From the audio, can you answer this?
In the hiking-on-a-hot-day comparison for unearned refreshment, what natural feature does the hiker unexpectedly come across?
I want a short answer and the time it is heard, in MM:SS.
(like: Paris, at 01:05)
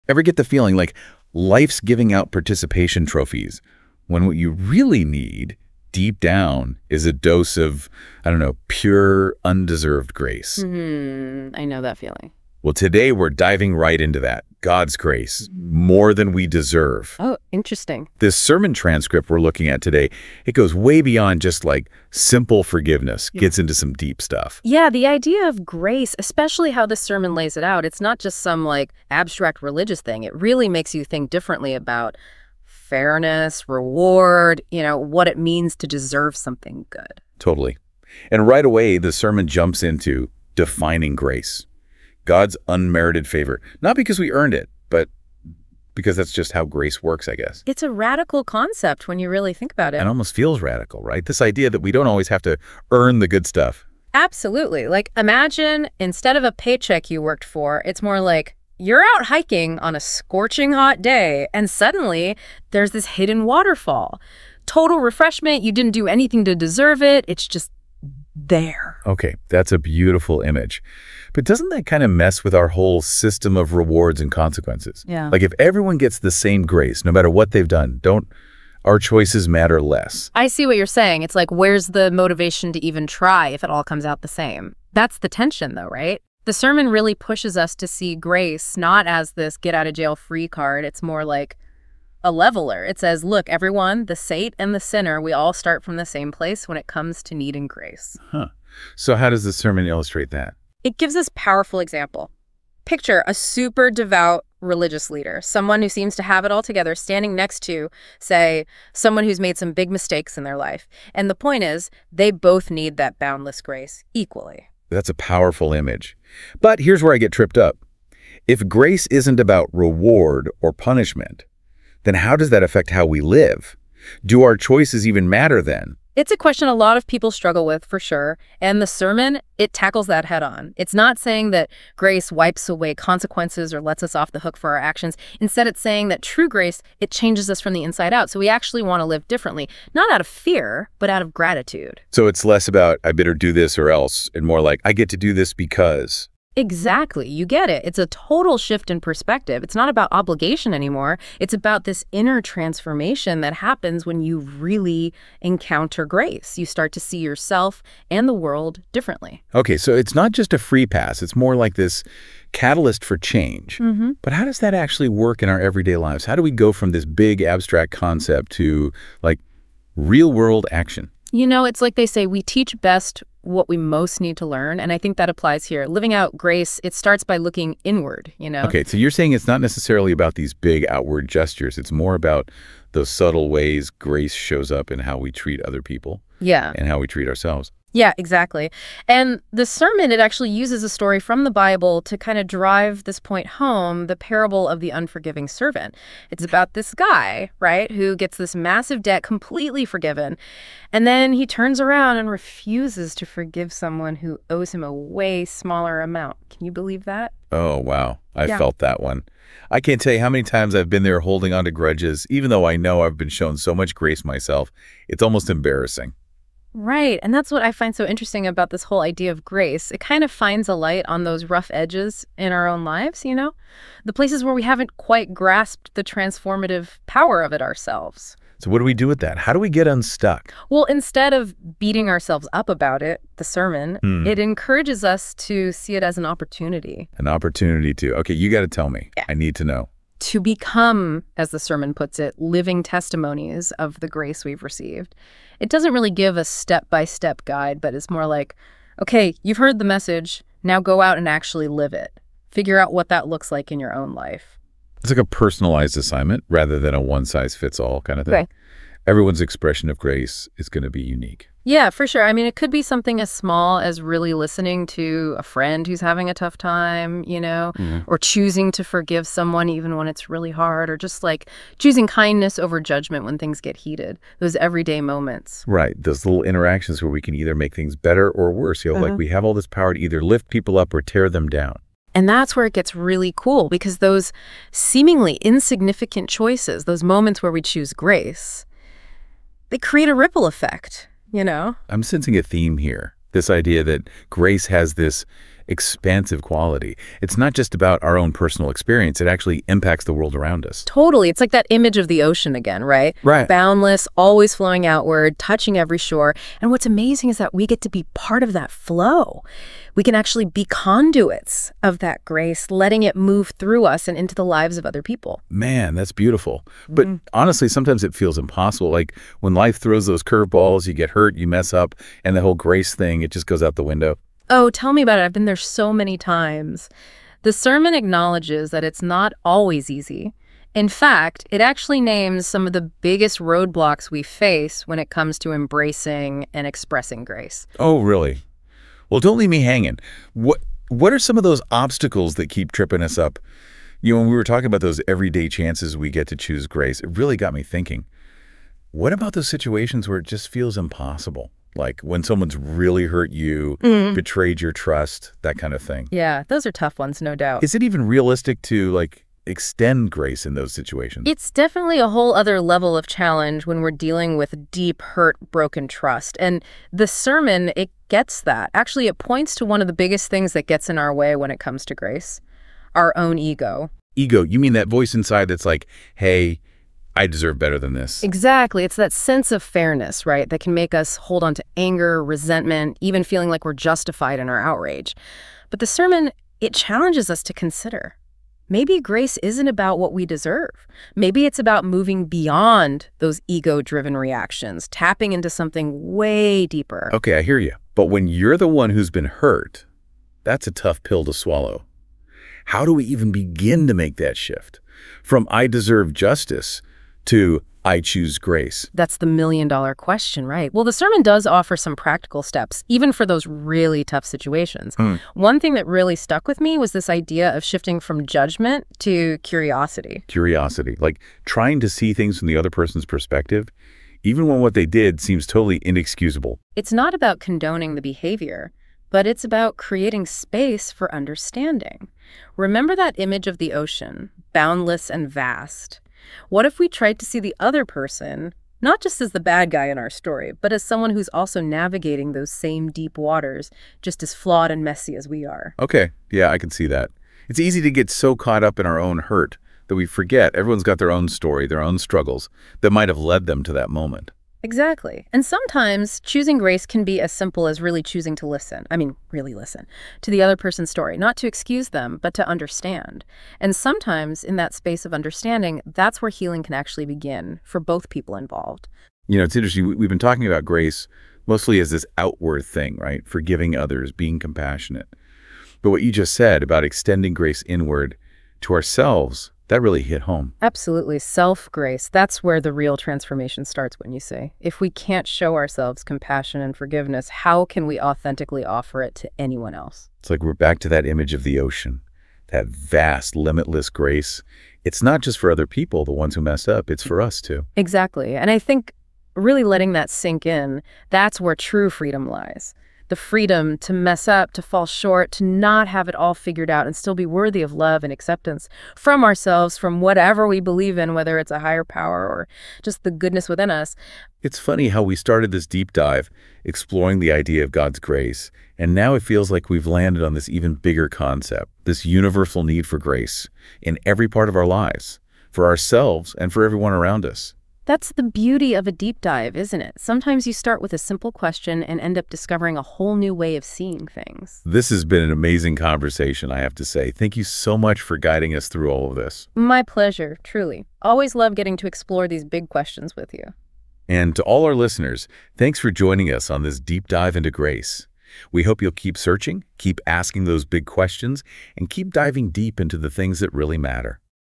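hidden waterfall, at 01:03.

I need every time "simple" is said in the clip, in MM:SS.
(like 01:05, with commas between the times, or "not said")
00:22, 07:37, 08:50.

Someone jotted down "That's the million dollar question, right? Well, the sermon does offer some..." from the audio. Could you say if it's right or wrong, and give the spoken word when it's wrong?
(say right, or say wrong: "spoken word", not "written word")
right.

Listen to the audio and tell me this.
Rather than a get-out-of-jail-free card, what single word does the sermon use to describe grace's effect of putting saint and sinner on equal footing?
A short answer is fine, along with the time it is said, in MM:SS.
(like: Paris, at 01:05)
leveler, at 01:32.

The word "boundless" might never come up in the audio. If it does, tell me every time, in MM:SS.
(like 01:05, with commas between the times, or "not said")
01:53, 05:03, 07:14.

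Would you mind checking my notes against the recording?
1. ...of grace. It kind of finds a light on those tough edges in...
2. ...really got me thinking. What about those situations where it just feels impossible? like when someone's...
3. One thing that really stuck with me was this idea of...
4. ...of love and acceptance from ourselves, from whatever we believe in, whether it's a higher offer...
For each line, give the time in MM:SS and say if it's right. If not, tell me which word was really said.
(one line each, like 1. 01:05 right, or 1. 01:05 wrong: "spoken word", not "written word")
1. 03:39 wrong: "rough", not "tough"
2. 05:47 right
3. 06:55 right
4. 08:27 wrong: "power", not "offer".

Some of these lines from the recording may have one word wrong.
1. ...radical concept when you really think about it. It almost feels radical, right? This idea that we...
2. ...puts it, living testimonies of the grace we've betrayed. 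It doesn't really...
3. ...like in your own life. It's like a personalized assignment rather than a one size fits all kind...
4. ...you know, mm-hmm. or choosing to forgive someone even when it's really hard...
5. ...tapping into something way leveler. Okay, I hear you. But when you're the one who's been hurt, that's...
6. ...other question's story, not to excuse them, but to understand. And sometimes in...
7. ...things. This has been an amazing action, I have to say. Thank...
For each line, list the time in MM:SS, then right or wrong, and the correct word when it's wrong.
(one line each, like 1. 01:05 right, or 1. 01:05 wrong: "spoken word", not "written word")
1. 00:47 right
2. 04:01 wrong: "received", not "betrayed"
3. 04:13 right
4. 04:27 right
5. 06:34 wrong: "deeper", not "leveler"
6. 07:40 wrong: "person", not "question"
7. 08:54 wrong: "conversation", not "action".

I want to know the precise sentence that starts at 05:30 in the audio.
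In fact, it actually names some of the biggest roadblocks we face when it comes to embracing and expressing grace.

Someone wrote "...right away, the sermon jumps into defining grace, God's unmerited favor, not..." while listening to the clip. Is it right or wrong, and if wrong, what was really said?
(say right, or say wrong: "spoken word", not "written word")
right.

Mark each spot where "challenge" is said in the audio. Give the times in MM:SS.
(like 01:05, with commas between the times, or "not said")
06:03, 06:26.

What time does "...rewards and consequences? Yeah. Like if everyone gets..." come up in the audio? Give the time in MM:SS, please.
01:13.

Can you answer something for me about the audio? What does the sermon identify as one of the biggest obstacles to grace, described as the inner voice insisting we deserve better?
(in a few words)
ego.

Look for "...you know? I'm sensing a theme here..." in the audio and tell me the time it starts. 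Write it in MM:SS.
04:51.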